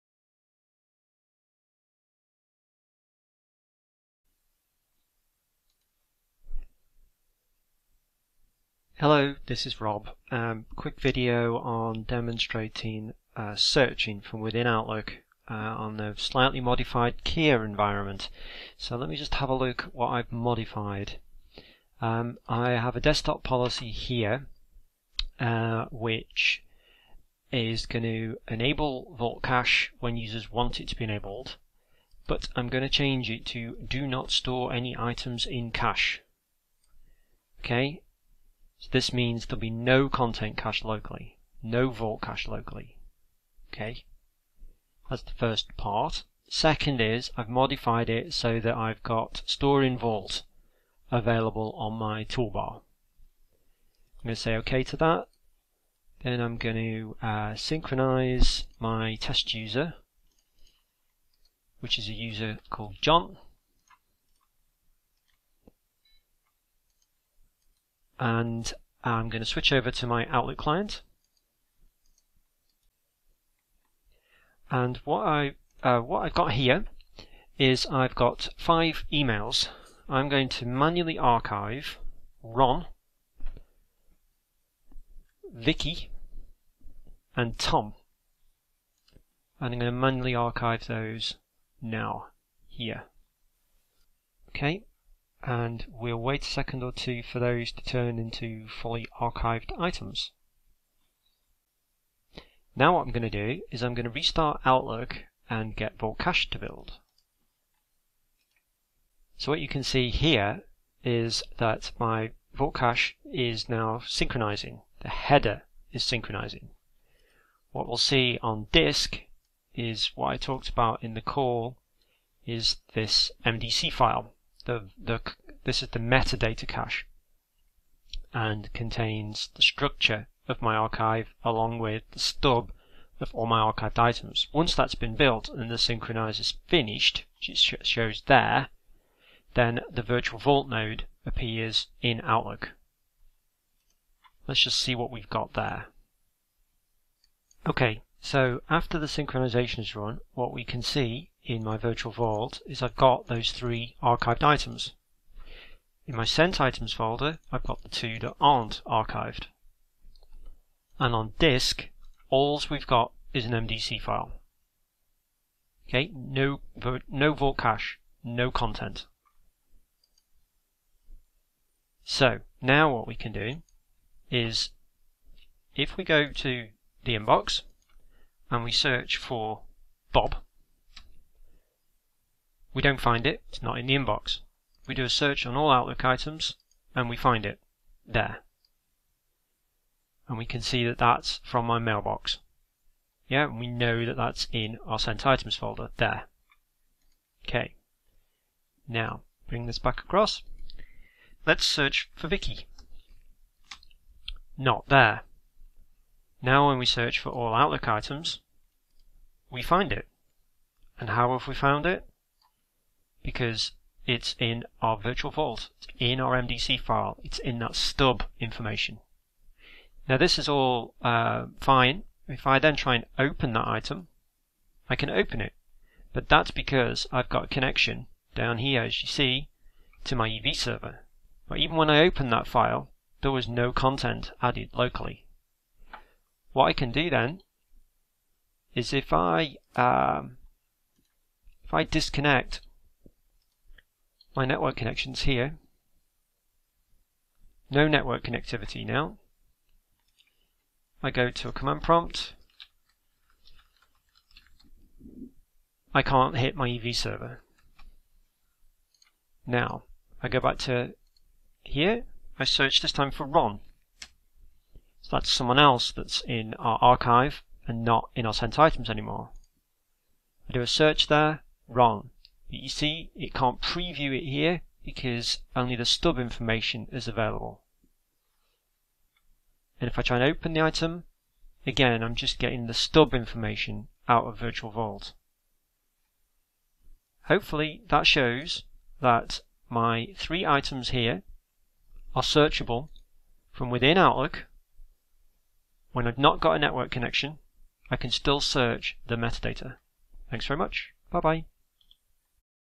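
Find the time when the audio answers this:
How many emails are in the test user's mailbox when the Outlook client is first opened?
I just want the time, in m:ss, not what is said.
1:18.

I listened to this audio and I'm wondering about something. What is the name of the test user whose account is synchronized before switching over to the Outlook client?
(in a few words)
John.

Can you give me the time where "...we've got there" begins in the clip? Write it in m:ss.
2:25.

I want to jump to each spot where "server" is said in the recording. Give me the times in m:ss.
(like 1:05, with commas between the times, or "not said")
3:50, 4:16.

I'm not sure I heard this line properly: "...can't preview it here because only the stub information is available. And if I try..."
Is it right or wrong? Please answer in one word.
right.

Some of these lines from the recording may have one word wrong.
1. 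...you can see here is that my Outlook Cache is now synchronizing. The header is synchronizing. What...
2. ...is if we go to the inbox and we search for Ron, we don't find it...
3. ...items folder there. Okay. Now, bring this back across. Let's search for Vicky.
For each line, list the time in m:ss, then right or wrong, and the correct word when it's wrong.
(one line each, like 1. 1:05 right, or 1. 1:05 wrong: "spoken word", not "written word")
1. 1:49 wrong: "Vault", not "Outlook"
2. 2:54 wrong: "Bob", not "Ron"
3. 3:15 right.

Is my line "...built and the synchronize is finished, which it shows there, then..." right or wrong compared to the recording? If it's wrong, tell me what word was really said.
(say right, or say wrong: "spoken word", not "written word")
right.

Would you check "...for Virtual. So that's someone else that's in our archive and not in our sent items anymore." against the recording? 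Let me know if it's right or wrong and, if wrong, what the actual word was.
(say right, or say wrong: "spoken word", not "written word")
wrong: "Ron", not "Virtual".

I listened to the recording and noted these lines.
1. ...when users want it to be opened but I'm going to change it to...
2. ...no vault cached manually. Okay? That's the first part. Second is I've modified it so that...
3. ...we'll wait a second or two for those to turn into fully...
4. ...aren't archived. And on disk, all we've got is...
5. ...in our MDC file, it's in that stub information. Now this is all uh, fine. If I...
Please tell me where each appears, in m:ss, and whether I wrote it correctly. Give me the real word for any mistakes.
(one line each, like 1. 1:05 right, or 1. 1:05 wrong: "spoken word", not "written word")
1. 0:29 wrong: "enabled", not "opened"
2. 0:41 wrong: "locally", not "manually"
3. 1:35 right
4. 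2:38 right
5. 3:35 right.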